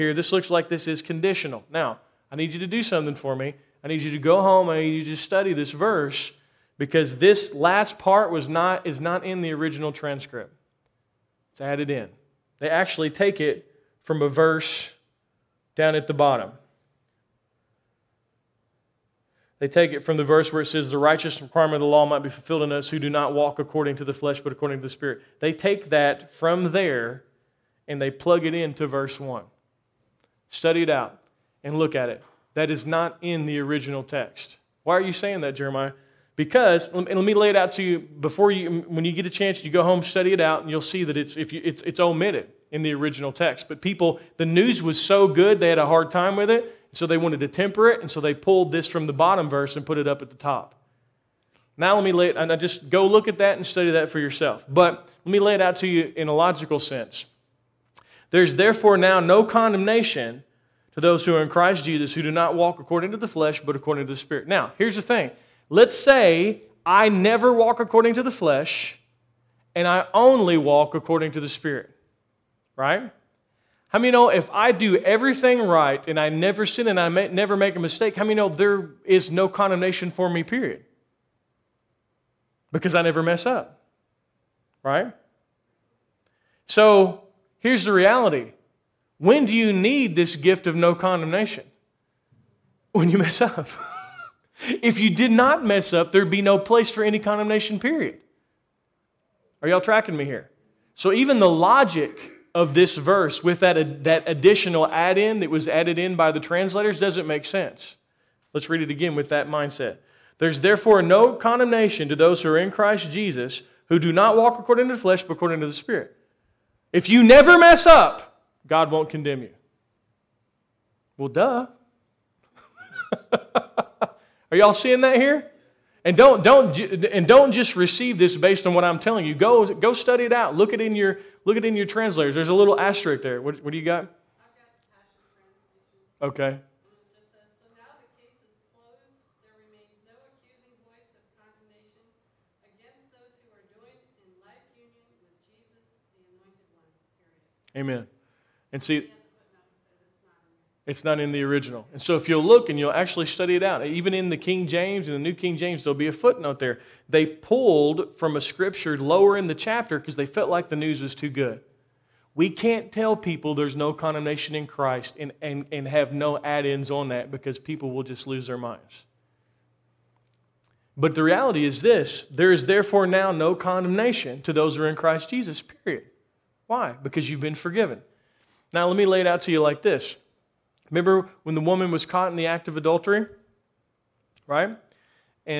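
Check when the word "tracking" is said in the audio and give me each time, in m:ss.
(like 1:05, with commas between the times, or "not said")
1:39.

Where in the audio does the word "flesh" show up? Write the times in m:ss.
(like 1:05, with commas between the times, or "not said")
0:24, 1:03, 1:08, 1:55.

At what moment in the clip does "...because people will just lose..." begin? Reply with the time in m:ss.
2:47.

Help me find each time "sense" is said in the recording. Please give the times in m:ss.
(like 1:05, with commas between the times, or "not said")
0:56, 1:47.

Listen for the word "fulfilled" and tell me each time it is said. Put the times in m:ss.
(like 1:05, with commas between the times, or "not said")
0:22.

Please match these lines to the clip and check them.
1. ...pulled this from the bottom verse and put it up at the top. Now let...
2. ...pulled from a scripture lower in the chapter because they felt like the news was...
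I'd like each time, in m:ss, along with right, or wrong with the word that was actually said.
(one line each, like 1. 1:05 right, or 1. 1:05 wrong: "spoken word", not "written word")
1. 0:48 right
2. 2:37 right.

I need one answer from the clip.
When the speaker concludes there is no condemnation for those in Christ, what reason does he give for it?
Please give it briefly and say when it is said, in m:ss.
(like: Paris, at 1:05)
You've been forgiven, at 2:57.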